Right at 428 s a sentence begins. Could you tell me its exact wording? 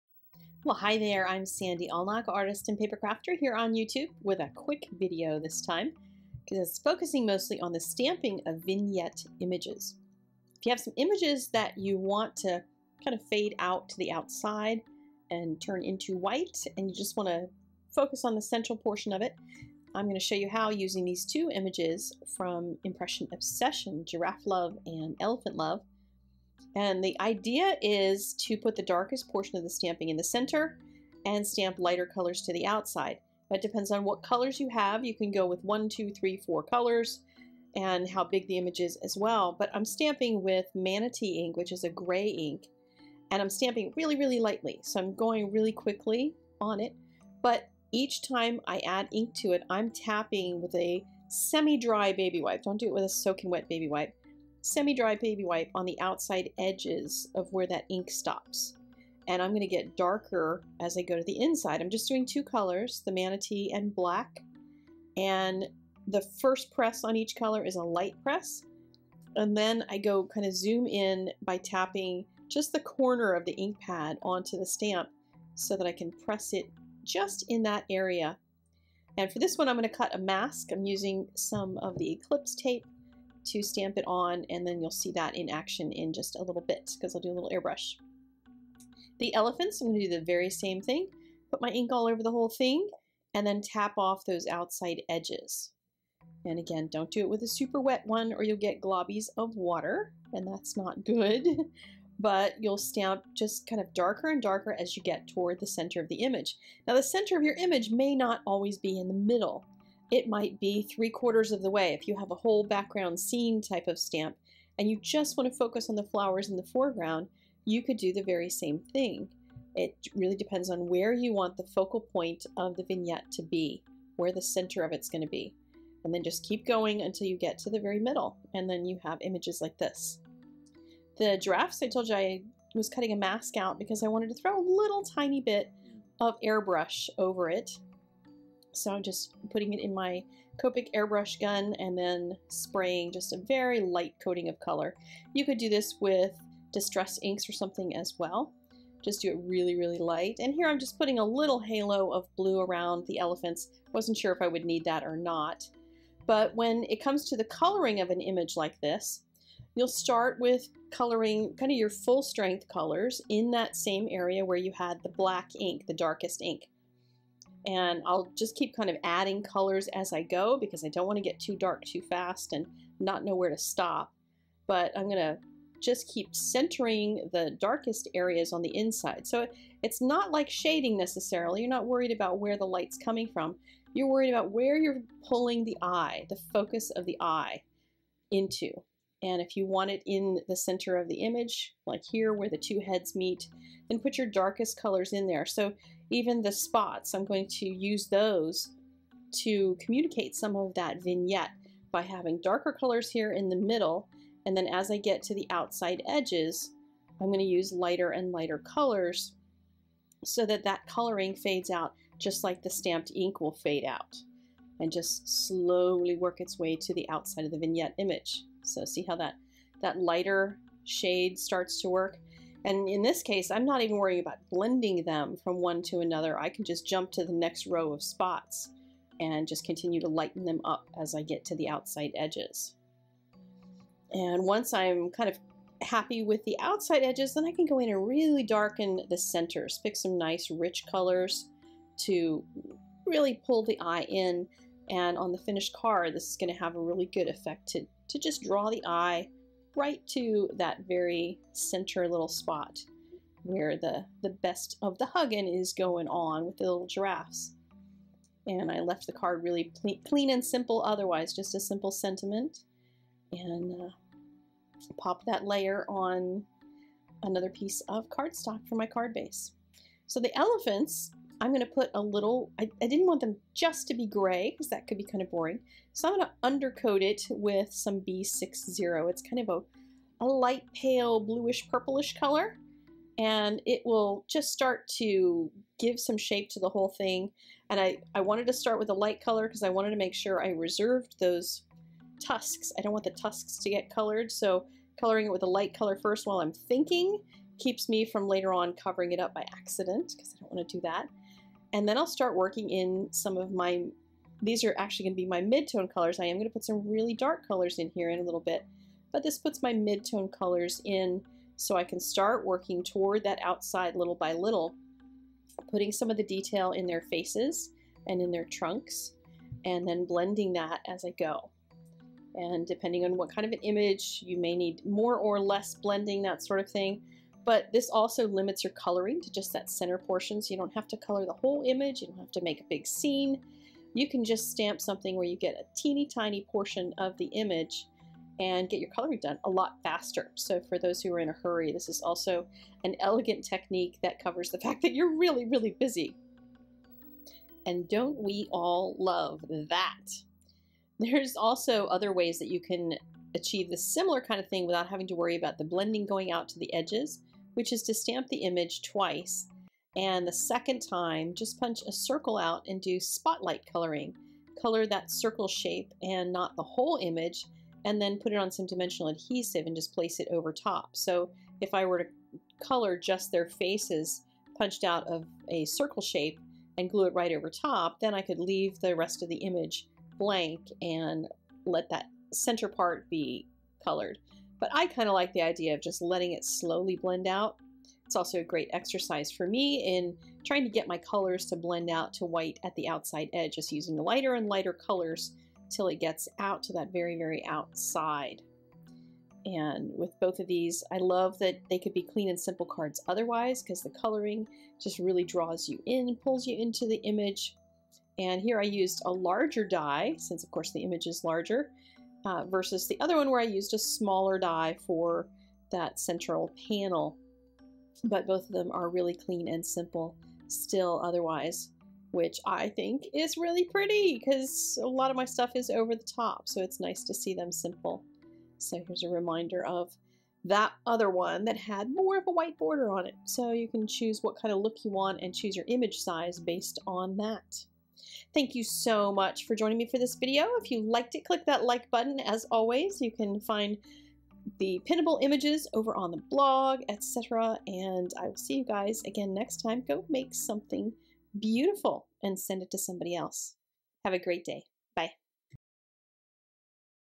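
So here's a reminder of that other one that had more of a white border on it.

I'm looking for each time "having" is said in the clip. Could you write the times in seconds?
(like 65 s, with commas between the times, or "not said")
202 s, 354 s.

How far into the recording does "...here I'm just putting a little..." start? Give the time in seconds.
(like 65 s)
150 s.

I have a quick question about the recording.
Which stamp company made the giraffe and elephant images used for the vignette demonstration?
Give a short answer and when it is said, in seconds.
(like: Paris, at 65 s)
Impression Obsession, at 22 s.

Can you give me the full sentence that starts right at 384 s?
But I kind of like the idea of just letting it slowly blend out.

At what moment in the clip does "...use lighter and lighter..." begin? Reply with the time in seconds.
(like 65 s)
207 s.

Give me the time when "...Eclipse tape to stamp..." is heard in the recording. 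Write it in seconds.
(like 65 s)
82 s.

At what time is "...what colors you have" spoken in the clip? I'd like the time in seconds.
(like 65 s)
34 s.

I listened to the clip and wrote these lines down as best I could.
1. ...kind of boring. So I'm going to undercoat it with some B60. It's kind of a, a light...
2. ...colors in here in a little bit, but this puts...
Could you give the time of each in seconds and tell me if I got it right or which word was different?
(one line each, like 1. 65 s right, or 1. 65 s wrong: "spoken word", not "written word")
1. 275 s right
2. 307 s right.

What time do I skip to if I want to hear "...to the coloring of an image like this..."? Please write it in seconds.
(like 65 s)
157 s.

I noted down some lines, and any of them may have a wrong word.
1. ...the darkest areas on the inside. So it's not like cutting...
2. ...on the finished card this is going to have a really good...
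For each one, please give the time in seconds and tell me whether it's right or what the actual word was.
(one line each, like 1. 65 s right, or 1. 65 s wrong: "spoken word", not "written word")
1. 177 s wrong: "shading", not "cutting"
2. 245 s right.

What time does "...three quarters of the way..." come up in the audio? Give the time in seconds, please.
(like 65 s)
110 s.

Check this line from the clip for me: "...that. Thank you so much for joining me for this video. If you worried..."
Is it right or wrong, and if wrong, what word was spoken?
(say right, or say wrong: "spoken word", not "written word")
wrong: "liked", not "worried".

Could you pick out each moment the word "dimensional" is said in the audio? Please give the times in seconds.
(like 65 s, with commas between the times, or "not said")
368 s.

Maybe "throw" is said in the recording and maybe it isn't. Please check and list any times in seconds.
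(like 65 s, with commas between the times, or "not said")
134 s.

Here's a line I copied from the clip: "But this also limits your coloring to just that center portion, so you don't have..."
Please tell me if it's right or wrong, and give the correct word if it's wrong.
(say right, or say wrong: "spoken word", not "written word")
right.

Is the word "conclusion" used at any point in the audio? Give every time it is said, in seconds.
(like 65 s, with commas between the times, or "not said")
not said.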